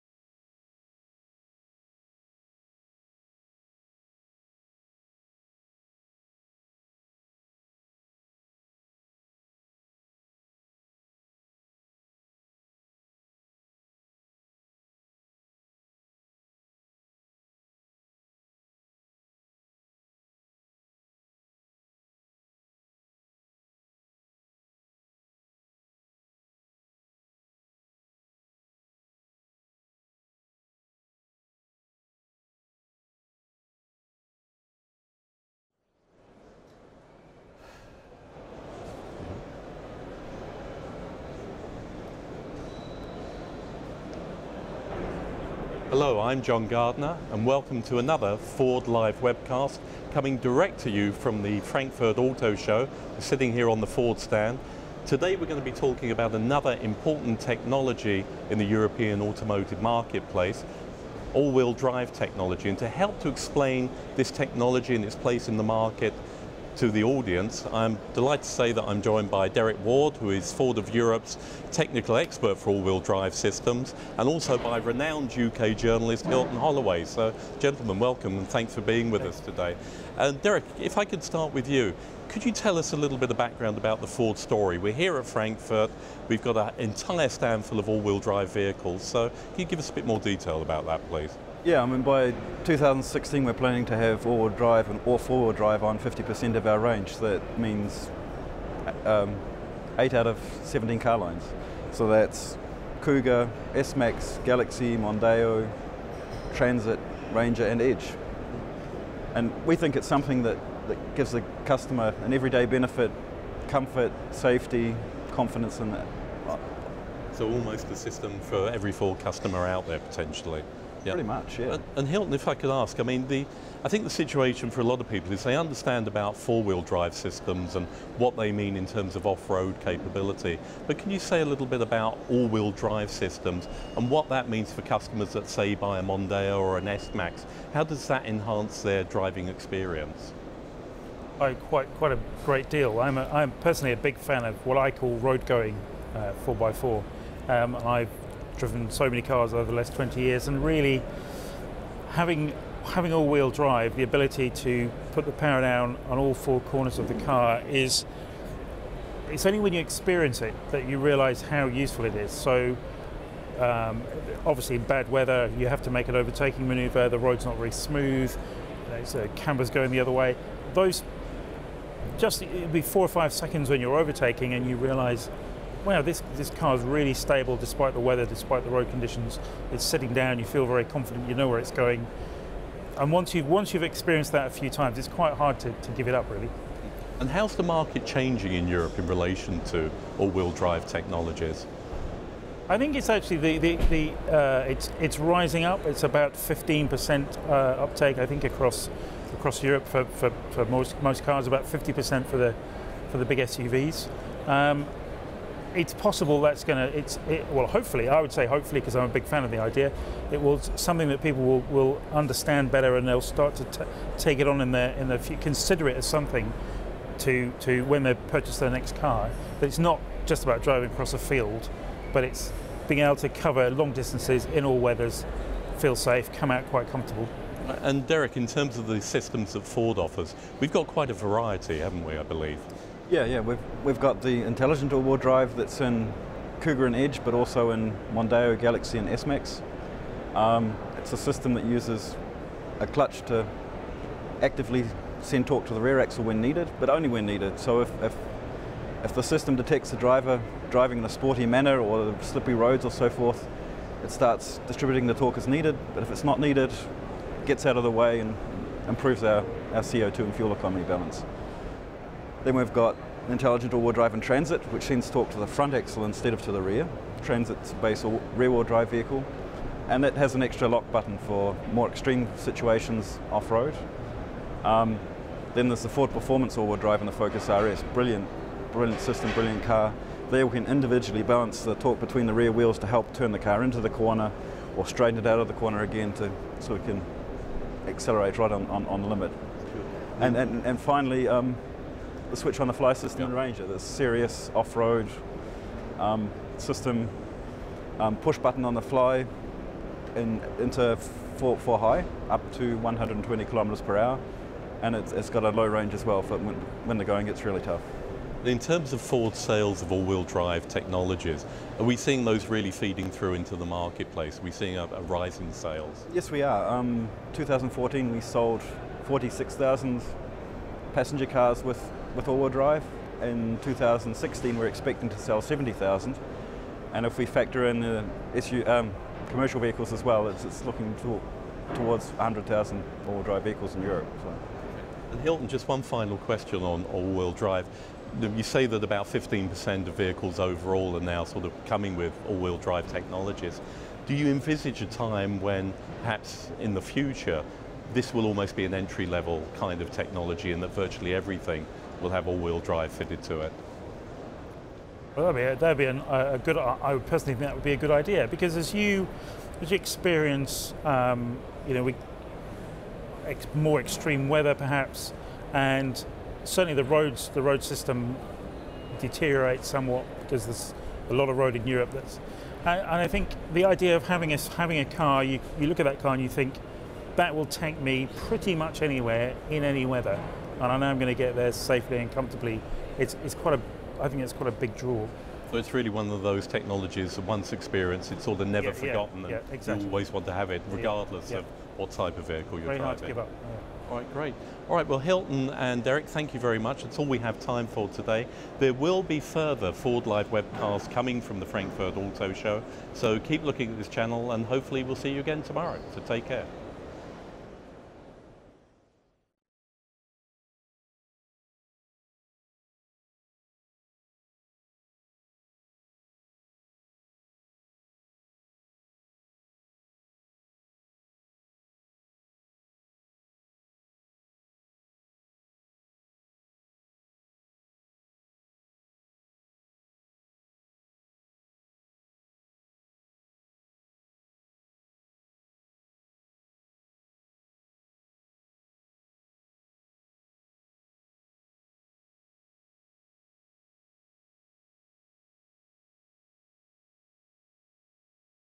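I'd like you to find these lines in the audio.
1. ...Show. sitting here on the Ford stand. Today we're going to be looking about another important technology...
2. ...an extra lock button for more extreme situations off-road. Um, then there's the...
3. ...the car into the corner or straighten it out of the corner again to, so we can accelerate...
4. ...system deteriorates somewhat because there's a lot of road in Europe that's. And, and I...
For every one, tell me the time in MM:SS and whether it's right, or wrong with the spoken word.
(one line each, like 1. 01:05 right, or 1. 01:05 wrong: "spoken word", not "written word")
1. 00:52 wrong: "talking", not "looking"
2. 04:30 right
3. 04:43 right
4. 06:07 right.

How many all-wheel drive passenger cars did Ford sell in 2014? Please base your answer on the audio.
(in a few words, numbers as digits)
46,000.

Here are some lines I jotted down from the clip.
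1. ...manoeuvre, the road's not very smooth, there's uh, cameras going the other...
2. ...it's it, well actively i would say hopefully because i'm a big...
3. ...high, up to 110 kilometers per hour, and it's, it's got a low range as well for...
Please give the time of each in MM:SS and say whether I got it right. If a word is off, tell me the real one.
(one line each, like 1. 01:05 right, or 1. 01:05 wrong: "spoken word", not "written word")
1. 02:46 right
2. 03:26 wrong: "hopefully", not "actively"
3. 05:01 wrong: "120", not "110".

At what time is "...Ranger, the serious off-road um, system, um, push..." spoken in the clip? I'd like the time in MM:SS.
04:53.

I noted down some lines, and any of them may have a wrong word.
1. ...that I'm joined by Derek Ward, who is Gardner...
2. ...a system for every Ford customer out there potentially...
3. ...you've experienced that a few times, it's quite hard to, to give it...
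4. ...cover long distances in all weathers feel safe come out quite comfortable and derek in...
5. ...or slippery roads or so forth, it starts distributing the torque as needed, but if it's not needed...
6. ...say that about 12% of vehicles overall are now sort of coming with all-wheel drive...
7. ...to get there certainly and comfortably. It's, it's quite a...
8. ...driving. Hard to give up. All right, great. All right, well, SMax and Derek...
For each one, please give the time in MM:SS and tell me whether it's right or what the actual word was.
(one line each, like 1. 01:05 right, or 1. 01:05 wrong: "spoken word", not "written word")
1. 01:08 wrong: "Ford", not "Gardner"
2. 01:57 right
3. 03:03 right
4. 03:43 right
5. 04:11 right
6. 05:38 wrong: "15", not "12"
7. 06:21 wrong: "safely", not "certainly"
8. 06:32 wrong: "Hilton", not "SMax".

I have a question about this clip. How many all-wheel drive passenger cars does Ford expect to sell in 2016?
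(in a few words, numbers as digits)
70,000.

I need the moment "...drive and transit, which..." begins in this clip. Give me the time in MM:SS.
04:23.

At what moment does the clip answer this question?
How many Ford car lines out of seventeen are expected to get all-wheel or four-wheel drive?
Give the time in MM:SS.
01:39.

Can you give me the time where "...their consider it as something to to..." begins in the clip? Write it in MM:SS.
03:35.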